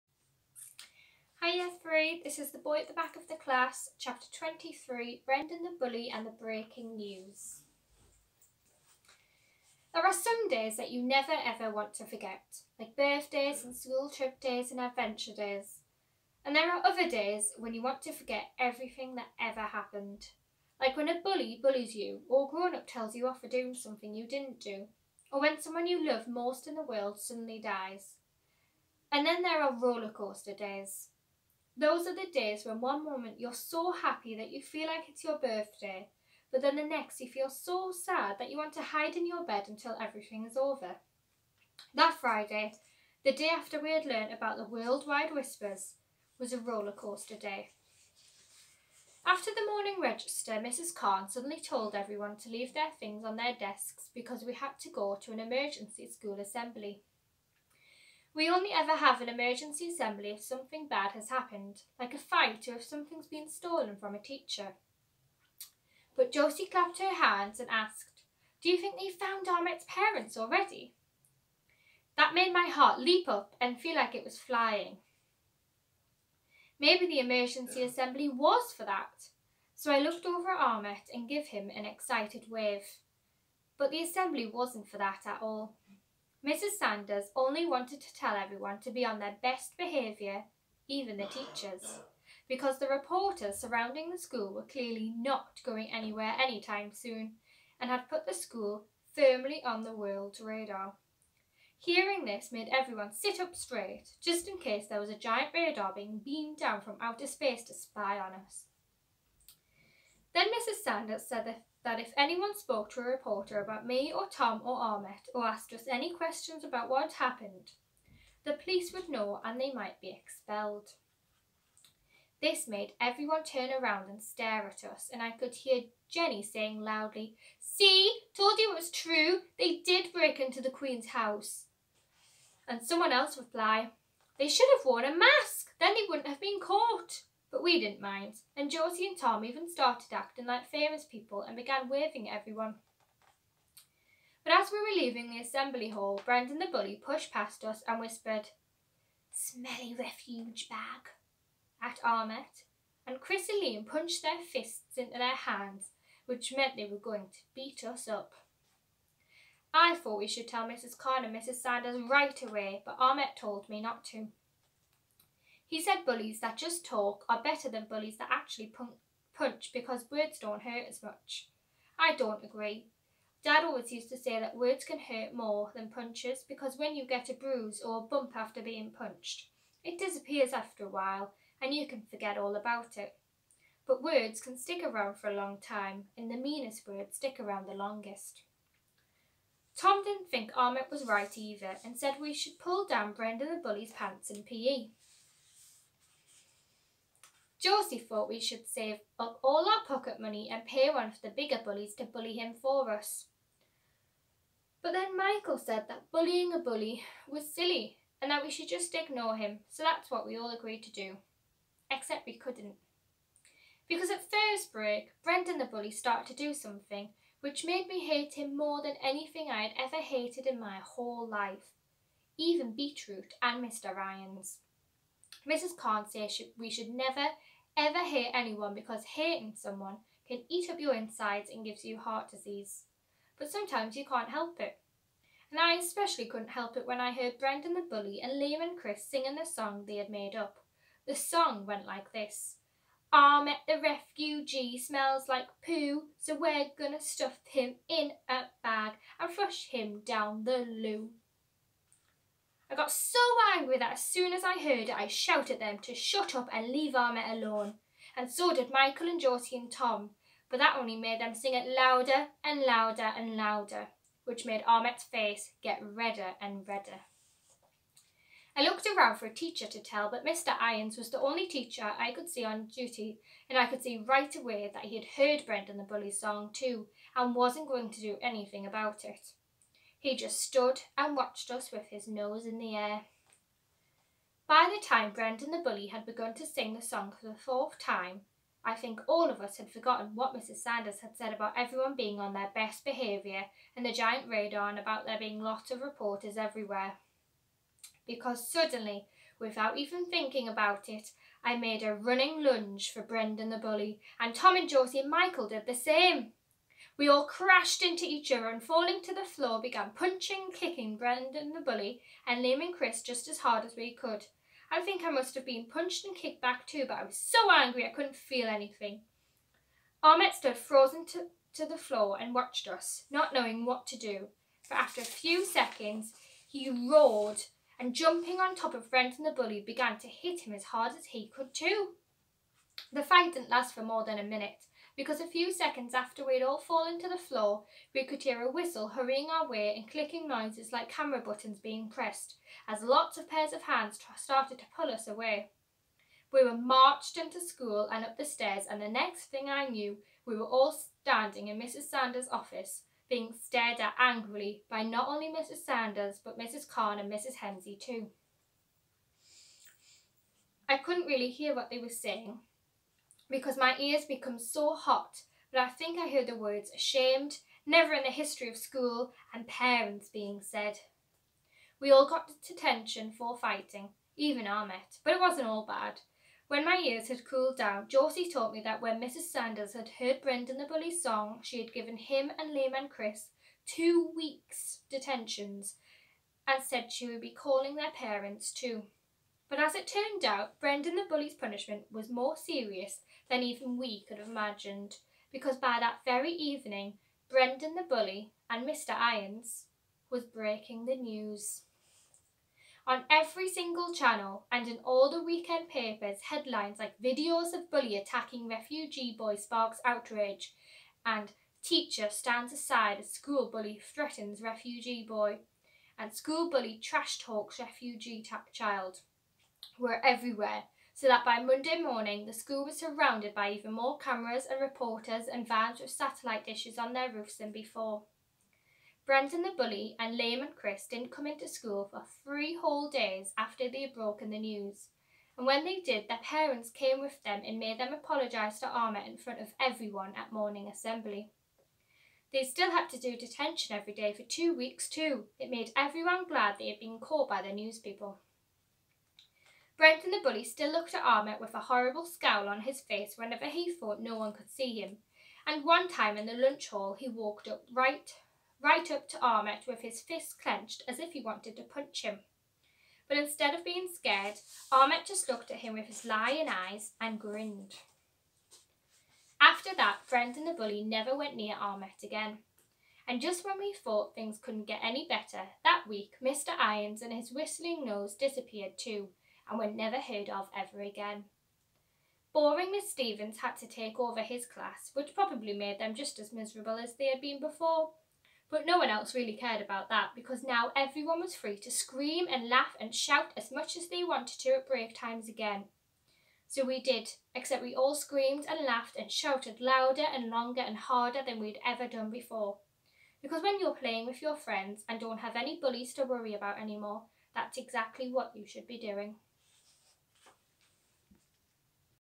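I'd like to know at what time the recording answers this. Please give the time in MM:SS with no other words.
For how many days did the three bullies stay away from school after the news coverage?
07:12.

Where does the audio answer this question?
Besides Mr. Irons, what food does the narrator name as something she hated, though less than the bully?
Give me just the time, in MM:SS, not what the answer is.
03:42.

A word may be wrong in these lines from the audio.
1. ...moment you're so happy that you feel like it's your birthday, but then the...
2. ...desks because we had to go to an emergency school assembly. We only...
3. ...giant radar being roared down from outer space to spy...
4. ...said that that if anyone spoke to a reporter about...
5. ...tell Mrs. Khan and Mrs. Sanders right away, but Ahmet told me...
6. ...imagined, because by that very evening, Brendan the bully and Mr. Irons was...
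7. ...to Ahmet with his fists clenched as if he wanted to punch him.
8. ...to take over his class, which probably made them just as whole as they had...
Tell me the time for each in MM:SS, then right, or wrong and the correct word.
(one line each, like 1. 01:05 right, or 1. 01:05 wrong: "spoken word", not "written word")
1. 00:33 right
2. 00:53 right
3. 01:45 wrong: "beamed", not "roared"
4. 01:51 right
5. 02:40 right
6. 06:34 right
7. 07:39 right
8. 08:03 wrong: "miserable", not "whole".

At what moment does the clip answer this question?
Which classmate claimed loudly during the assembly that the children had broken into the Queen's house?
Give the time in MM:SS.
02:06.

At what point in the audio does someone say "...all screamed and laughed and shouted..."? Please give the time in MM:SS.
08:17.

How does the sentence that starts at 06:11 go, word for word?
We all got detention for fighting, even Ahmet, but it wasn't all bad.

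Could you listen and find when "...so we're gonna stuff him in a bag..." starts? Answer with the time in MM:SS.
04:06.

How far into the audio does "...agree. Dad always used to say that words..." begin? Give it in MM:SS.
02:52.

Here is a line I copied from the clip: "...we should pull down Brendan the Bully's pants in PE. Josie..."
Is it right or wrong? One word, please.
right.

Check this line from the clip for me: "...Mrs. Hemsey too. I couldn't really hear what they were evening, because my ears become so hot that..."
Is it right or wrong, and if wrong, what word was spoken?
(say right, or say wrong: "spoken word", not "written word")
wrong: "saying", not "evening".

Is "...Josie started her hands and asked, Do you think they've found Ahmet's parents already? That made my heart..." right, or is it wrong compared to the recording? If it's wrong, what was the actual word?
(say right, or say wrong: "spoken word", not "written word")
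wrong: "clapped", not "started".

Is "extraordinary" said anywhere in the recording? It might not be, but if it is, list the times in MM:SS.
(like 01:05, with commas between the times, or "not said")
not said.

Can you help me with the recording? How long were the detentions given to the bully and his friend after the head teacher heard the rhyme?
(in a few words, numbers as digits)
2 weeks.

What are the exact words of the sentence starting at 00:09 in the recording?
There are some days that you never ever want to forget, like birthdays and school trip days and adventure days.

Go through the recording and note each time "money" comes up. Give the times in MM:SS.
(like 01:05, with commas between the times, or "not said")
03:20.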